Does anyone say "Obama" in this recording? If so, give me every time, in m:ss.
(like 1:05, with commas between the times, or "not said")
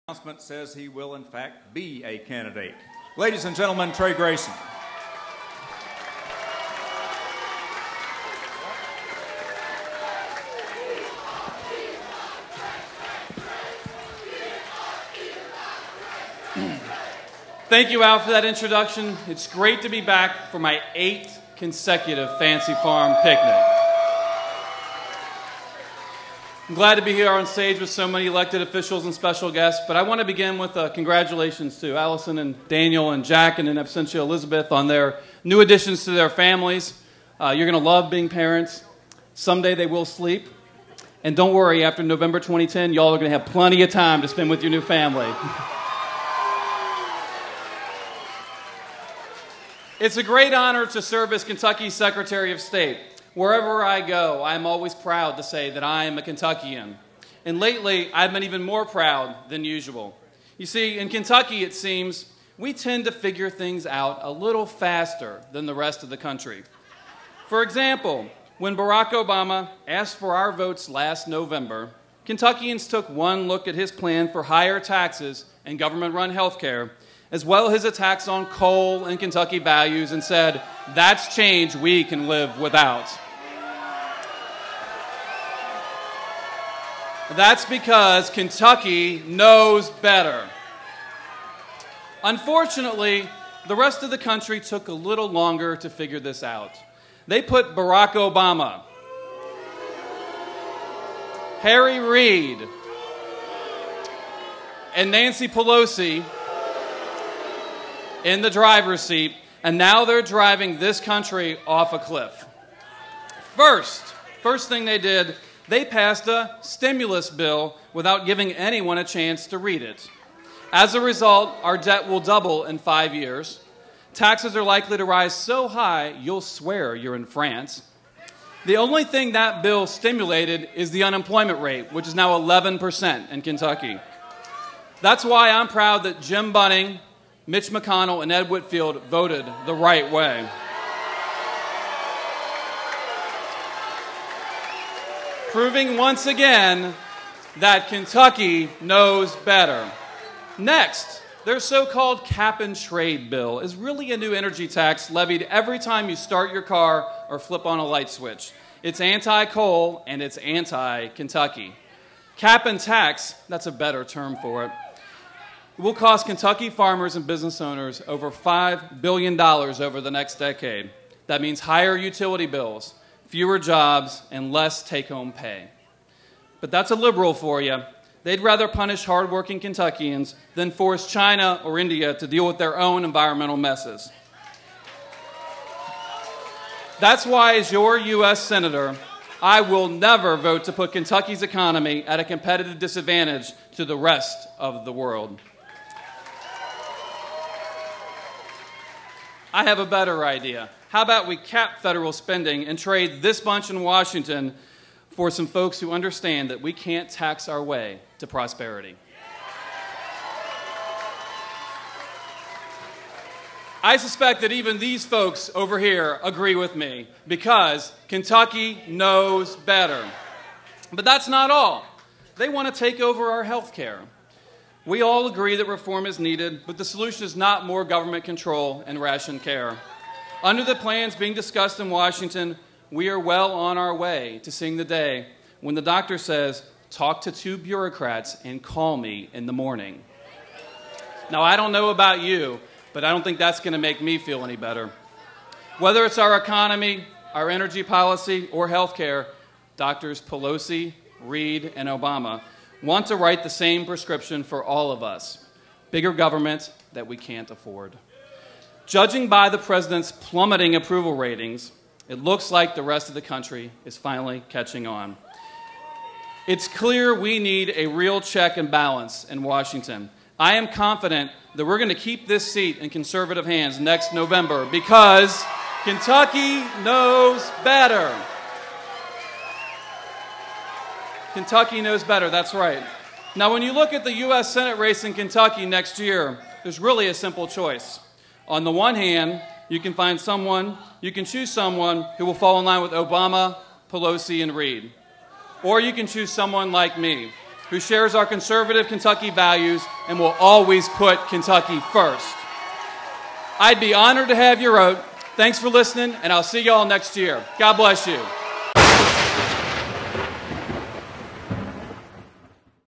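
1:09, 1:38, 4:11, 4:52.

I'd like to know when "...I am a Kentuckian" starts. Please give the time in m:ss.
0:55.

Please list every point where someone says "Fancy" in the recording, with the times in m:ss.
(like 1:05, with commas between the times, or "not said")
0:22.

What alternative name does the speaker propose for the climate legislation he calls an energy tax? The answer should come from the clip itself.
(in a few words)
Cap and tax.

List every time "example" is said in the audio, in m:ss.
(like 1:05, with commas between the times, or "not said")
1:07.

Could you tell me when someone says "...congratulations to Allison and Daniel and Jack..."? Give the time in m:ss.
0:30.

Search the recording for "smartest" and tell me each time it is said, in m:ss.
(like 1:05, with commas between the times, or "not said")
not said.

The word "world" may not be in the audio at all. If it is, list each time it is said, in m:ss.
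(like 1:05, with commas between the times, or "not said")
3:14.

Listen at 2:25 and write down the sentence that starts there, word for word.
Proving once again that Kentucky knows better.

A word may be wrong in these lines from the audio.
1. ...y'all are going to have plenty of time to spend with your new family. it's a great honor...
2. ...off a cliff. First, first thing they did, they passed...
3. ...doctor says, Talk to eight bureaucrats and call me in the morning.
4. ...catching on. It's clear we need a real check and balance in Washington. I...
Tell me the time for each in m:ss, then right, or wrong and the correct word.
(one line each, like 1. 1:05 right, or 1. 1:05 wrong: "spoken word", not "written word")
1. 0:42 right
2. 1:51 right
3. 3:55 wrong: "two", not "eight"
4. 4:24 right.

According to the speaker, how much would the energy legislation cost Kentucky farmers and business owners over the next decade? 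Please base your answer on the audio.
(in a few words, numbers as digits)
$5 billion.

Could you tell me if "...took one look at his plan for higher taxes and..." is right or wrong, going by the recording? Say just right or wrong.
right.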